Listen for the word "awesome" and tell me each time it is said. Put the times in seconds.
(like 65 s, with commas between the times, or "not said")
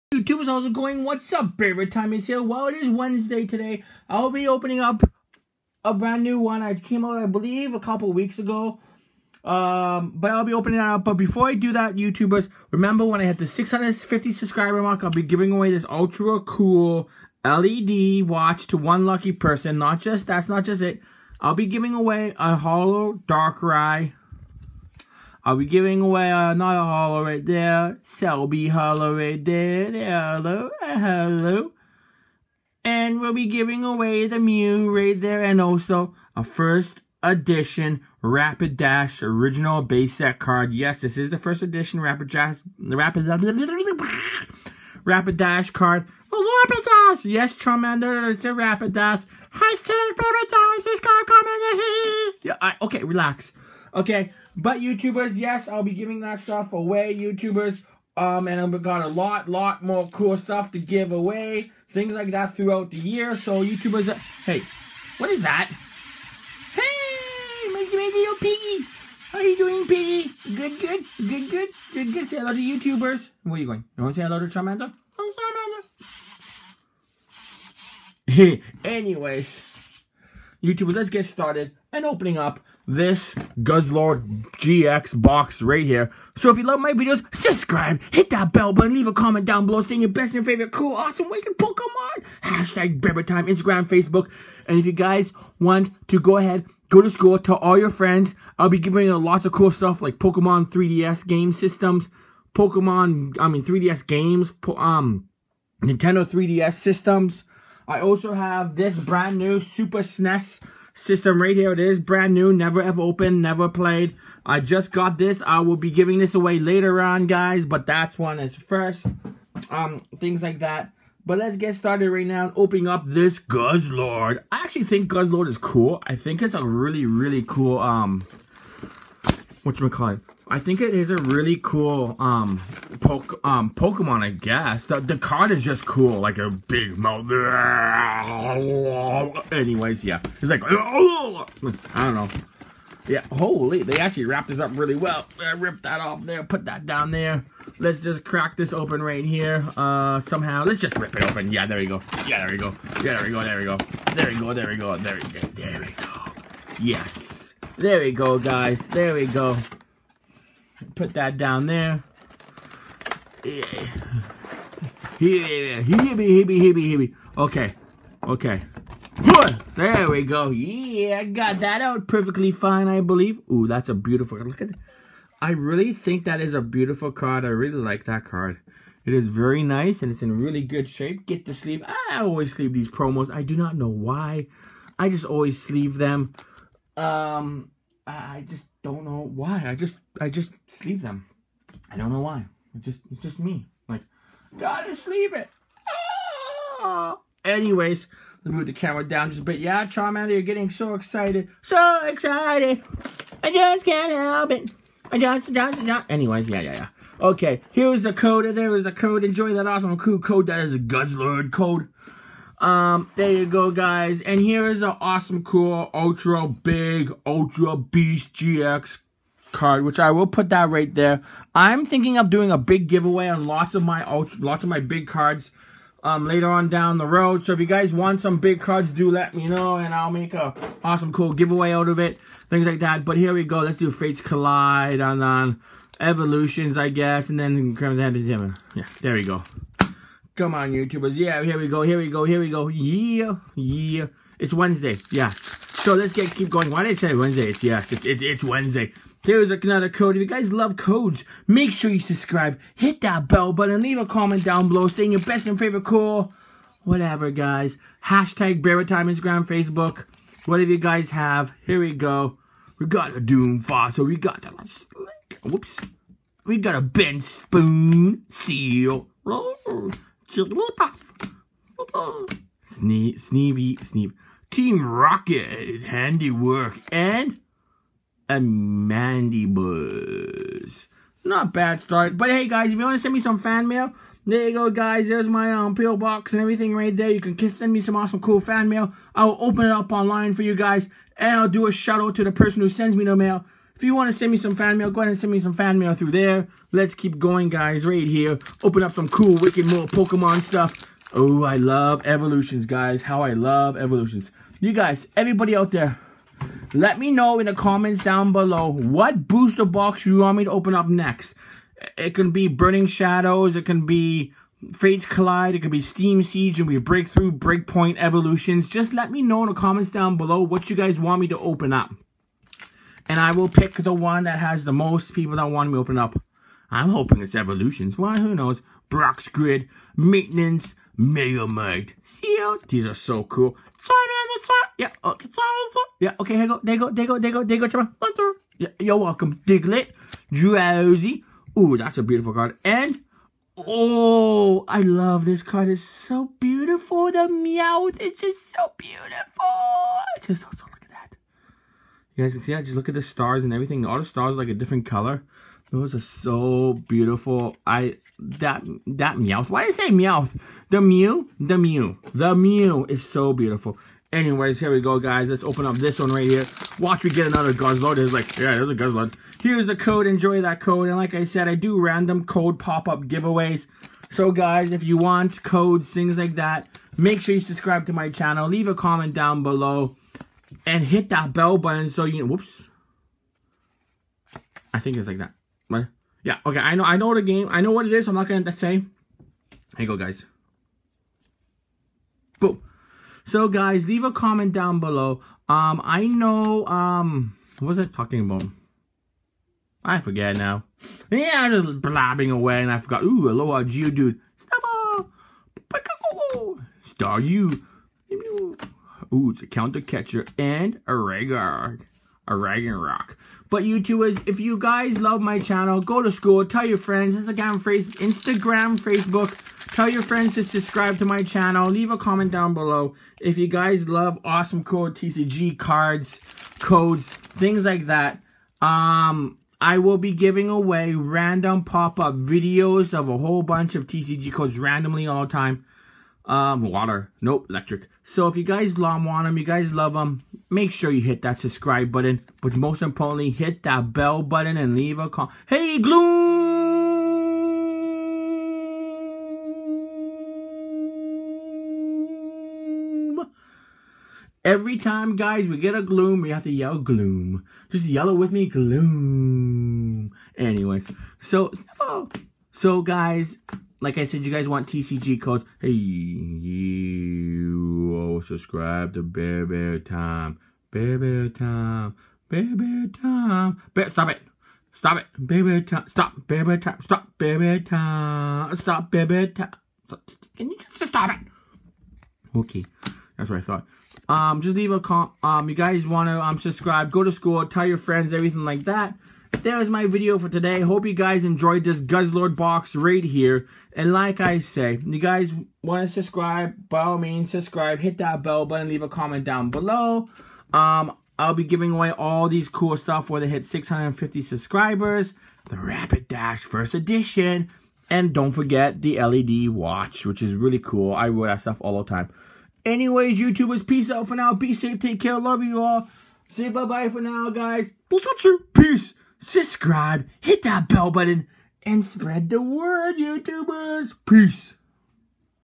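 90 s, 209 s, 215 s, 230 s, 287 s, 424 s.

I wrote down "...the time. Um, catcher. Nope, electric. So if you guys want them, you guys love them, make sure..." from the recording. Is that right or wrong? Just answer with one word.
wrong.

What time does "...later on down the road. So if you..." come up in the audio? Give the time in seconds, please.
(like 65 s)
226 s.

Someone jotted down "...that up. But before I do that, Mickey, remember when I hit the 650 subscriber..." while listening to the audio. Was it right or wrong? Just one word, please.
wrong.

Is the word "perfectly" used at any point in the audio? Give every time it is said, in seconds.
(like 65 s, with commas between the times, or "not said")
172 s.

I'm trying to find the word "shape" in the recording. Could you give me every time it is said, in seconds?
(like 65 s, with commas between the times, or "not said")
180 s.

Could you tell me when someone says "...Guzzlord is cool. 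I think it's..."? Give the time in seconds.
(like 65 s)
125 s.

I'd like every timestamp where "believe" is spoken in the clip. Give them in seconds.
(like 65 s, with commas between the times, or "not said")
7 s, 173 s.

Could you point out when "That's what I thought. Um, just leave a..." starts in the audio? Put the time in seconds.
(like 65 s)
483 s.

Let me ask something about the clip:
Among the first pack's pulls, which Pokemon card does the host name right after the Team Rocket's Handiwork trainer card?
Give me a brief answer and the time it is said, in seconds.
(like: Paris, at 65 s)
Mandibuzz, at 278 s.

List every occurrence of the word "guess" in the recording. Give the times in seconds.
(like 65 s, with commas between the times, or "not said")
134 s, 236 s.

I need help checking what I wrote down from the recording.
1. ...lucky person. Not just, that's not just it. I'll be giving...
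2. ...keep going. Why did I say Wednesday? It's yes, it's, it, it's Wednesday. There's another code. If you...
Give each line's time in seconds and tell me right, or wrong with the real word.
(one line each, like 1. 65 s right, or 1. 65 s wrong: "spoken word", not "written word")
1. 19 s right
2. 246 s right.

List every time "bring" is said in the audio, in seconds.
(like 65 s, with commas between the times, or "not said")
not said.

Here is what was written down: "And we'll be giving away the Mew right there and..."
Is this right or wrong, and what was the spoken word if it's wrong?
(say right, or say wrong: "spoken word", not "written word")
right.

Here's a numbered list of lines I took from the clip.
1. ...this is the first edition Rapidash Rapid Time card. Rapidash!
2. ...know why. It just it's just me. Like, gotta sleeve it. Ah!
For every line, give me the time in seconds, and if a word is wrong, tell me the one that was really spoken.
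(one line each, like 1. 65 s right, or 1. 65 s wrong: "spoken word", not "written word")
1. 41 s wrong: "Rapidash", not "Time"
2. 192 s right.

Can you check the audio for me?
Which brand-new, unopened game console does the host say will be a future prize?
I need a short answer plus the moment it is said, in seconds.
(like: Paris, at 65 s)
Super SNES, at 109 s.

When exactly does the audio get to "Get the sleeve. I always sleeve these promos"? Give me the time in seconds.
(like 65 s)
181 s.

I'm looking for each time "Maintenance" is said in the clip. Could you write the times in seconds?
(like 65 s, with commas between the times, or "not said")
329 s.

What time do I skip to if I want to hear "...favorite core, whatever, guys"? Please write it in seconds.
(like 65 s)
255 s.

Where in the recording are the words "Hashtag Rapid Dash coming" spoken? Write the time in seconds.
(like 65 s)
49 s.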